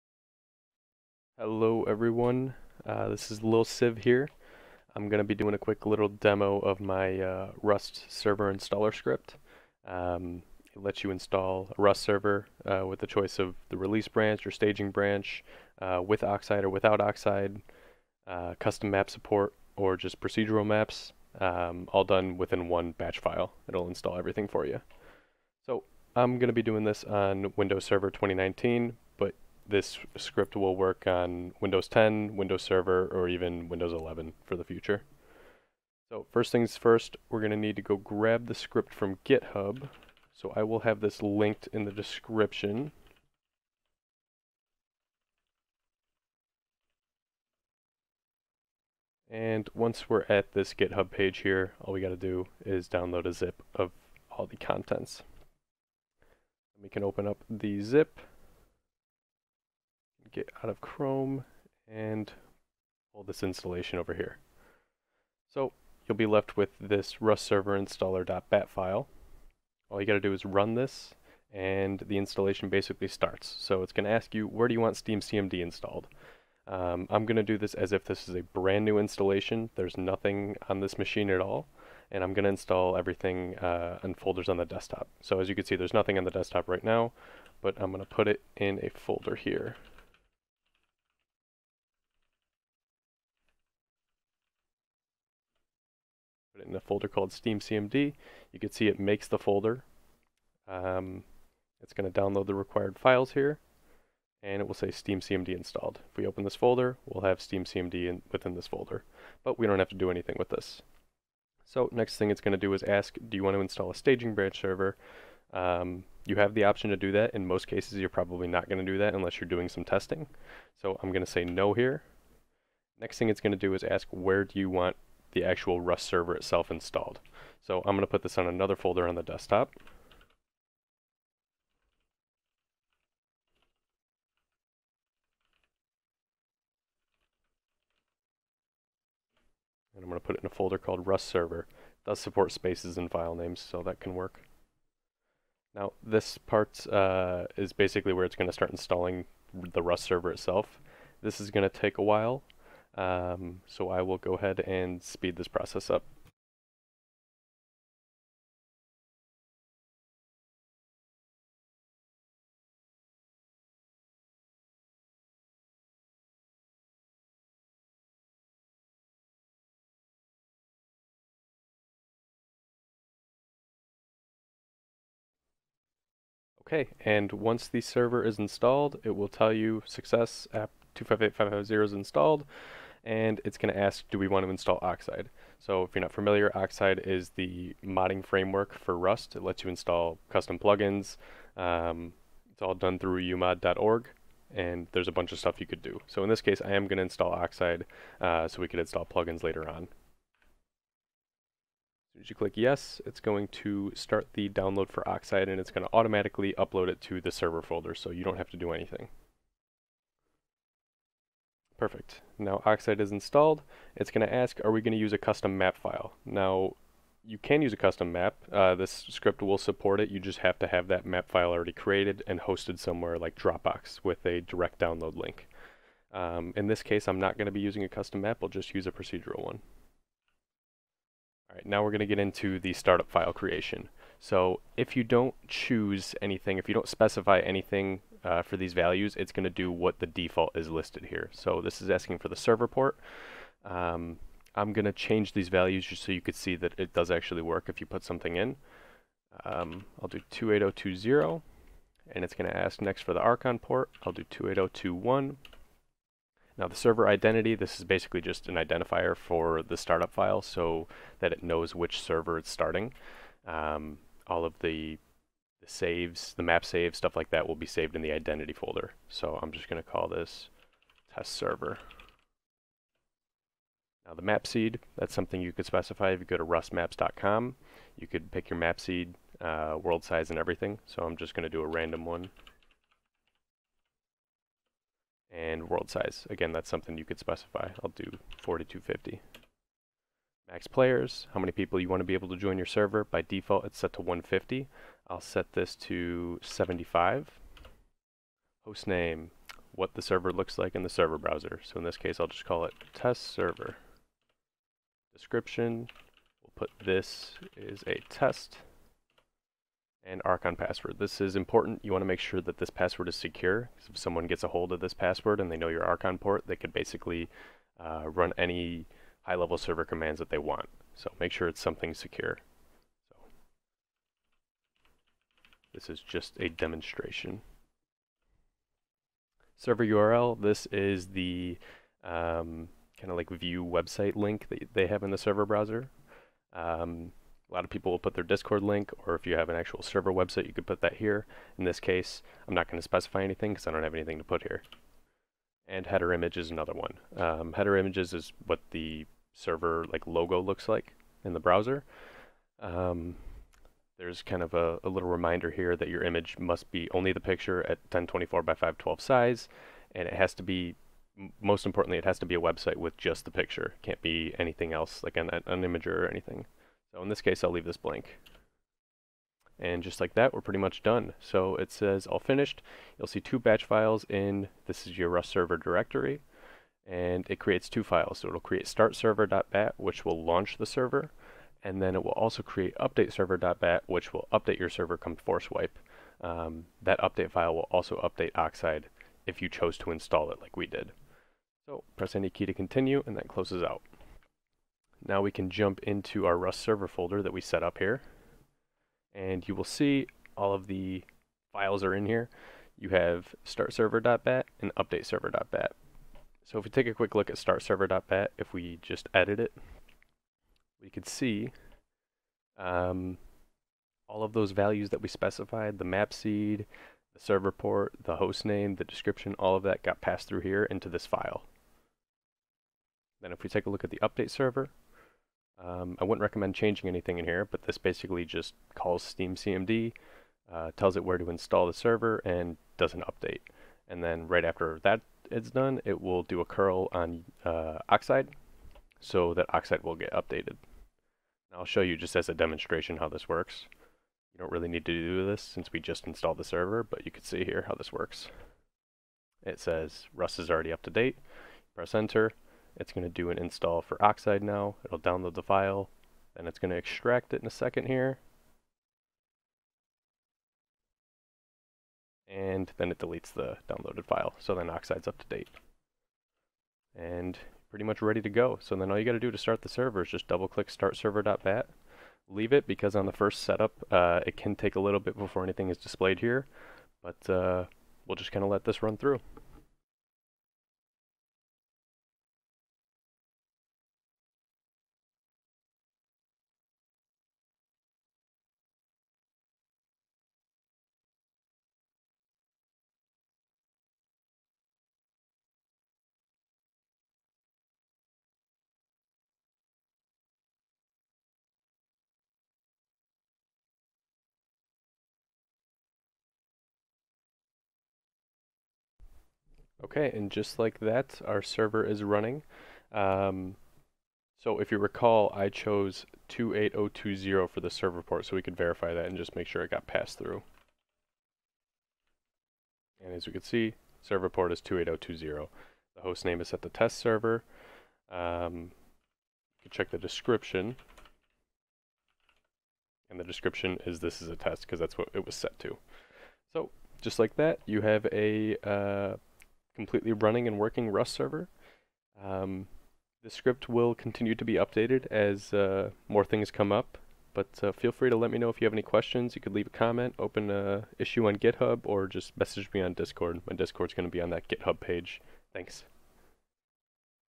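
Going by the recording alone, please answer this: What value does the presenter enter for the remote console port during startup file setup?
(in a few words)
28021.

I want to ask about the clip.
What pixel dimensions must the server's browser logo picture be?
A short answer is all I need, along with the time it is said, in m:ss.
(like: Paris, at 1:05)
1024 by 512, at 5:57.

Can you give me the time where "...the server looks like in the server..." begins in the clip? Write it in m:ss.
4:59.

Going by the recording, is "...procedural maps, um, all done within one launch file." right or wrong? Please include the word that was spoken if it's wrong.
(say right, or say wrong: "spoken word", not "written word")
wrong: "batch", not "launch".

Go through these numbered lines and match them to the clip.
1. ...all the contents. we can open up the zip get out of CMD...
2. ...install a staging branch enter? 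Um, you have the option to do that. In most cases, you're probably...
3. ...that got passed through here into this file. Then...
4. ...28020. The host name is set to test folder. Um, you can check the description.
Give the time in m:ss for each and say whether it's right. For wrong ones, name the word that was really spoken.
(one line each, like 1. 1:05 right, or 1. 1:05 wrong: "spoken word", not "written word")
1. 0:54 wrong: "Chrome", not "CMD"
2. 1:53 wrong: "server", not "enter"
3. 6:59 right
4. 8:44 wrong: "server", not "folder".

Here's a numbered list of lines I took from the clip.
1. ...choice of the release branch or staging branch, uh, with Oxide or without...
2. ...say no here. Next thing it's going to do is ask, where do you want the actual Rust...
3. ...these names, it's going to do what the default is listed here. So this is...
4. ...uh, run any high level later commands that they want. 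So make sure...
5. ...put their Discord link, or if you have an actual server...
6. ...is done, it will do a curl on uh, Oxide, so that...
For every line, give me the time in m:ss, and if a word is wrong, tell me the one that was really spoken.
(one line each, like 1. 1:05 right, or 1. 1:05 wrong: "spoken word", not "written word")
1. 0:13 right
2. 2:01 right
3. 3:58 wrong: "values", not "names"
4. 5:17 wrong: "server", not "later"
5. 5:37 right
6. 7:15 right.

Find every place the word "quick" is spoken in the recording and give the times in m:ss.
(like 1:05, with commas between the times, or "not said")
0:05, 6:46.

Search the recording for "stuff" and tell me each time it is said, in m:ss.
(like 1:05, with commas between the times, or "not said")
3:15, 4:26.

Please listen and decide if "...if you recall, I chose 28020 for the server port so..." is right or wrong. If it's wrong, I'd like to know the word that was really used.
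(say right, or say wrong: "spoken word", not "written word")
right.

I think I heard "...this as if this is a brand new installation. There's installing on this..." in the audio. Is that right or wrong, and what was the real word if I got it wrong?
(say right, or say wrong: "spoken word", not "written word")
wrong: "nothing", not "installing".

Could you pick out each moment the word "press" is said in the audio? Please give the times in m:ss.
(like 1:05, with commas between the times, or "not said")
6:31, 7:31.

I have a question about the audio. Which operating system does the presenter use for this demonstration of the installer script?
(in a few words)
Windows Server 2019.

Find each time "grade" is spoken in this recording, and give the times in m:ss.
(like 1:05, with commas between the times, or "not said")
not said.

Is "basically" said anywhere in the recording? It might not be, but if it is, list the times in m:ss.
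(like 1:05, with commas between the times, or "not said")
1:12, 2:27, 4:17, 5:16, 7:07.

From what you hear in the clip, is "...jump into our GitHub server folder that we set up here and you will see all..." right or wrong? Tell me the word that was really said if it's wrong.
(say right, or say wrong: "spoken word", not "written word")
wrong: "Rust", not "GitHub".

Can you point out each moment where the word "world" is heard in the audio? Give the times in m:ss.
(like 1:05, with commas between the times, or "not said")
4:39, 4:45.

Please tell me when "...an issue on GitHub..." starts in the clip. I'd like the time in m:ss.
9:10.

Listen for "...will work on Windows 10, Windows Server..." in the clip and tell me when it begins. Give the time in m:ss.
0:30.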